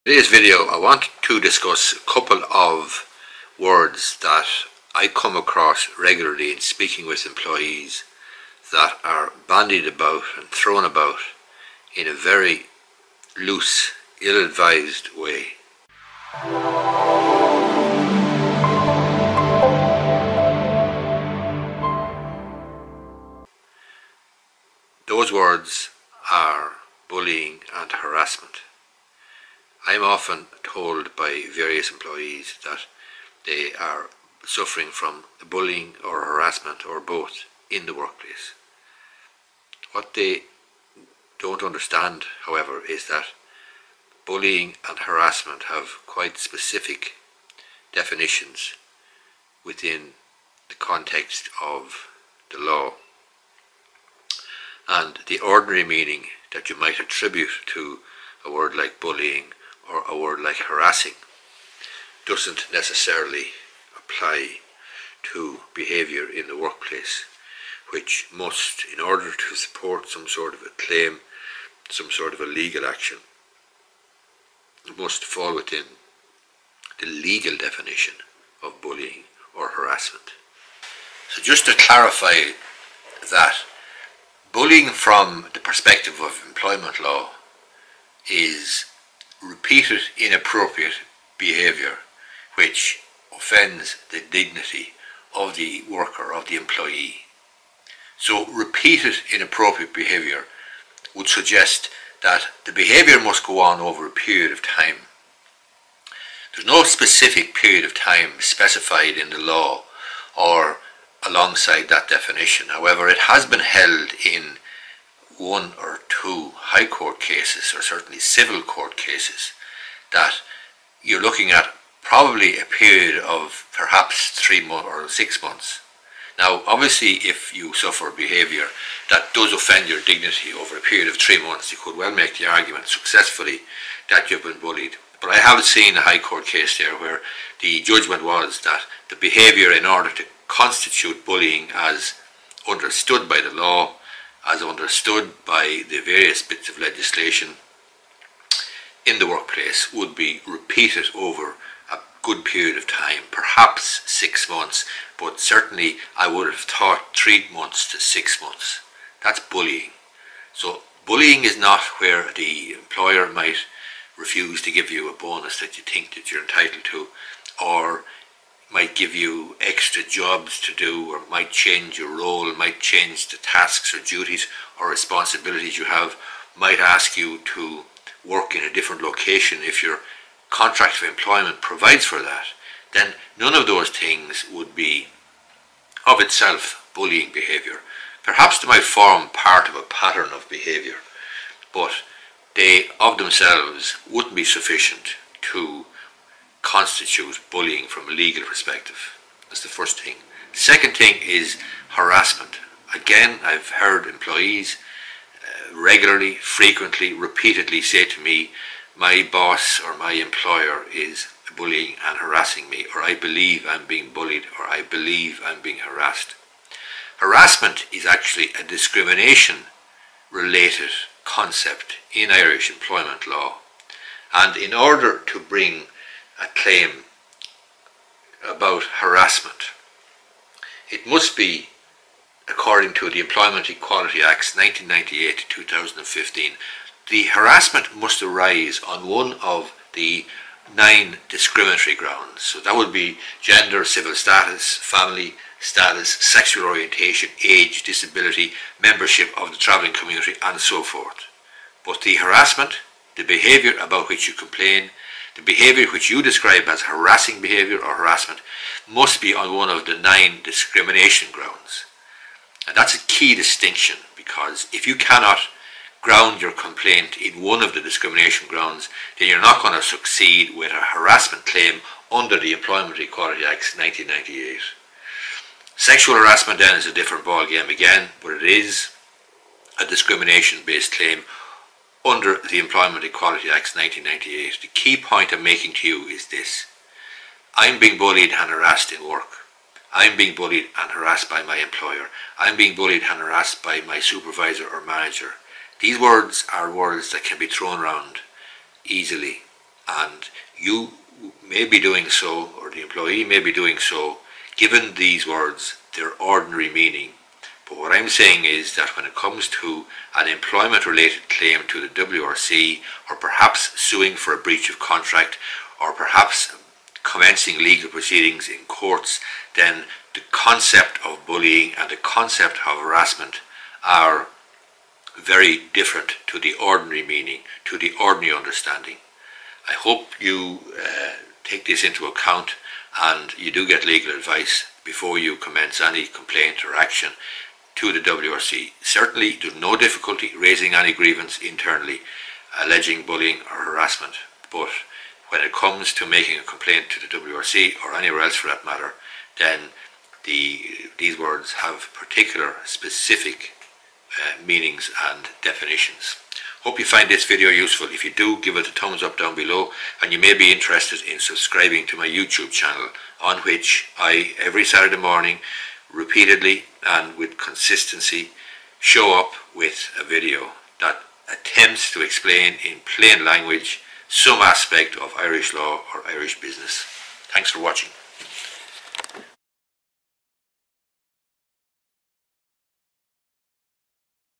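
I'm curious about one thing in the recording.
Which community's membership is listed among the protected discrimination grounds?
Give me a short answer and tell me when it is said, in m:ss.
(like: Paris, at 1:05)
Travelling community, at 4:09.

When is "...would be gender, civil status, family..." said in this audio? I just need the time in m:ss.
4:02.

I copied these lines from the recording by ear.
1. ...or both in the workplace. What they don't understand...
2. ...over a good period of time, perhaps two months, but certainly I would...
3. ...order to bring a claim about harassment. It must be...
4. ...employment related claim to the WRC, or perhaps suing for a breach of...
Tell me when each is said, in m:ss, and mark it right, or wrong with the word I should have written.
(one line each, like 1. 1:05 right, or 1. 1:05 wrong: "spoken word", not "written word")
1. 0:36 right
2. 2:31 wrong: "six", not "two"
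3. 3:44 right
4. 5:10 right.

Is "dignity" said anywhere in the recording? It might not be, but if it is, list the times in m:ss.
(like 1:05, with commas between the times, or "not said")
1:34, 2:10.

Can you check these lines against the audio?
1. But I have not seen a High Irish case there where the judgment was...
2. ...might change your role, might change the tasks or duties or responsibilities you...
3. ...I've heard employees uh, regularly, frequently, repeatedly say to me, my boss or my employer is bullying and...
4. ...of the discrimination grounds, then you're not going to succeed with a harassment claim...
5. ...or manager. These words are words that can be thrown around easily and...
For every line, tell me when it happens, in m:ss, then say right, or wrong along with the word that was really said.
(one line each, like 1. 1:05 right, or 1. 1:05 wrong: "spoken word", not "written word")
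1. 2:15 wrong: "Court", not "Irish"
2. 2:51 right
3. 3:23 right
4. 4:27 right
5. 4:54 right.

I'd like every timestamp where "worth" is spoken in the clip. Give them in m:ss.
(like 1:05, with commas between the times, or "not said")
not said.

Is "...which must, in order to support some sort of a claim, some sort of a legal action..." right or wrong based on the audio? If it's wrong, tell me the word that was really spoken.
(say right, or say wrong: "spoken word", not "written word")
right.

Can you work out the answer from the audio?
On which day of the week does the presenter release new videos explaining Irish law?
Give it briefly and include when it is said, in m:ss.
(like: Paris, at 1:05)
Saturday, at 6:04.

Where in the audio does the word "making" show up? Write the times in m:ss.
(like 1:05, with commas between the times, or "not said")
4:45, 5:46.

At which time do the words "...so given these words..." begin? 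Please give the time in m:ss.
5:03.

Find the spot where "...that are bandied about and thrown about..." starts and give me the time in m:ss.
0:08.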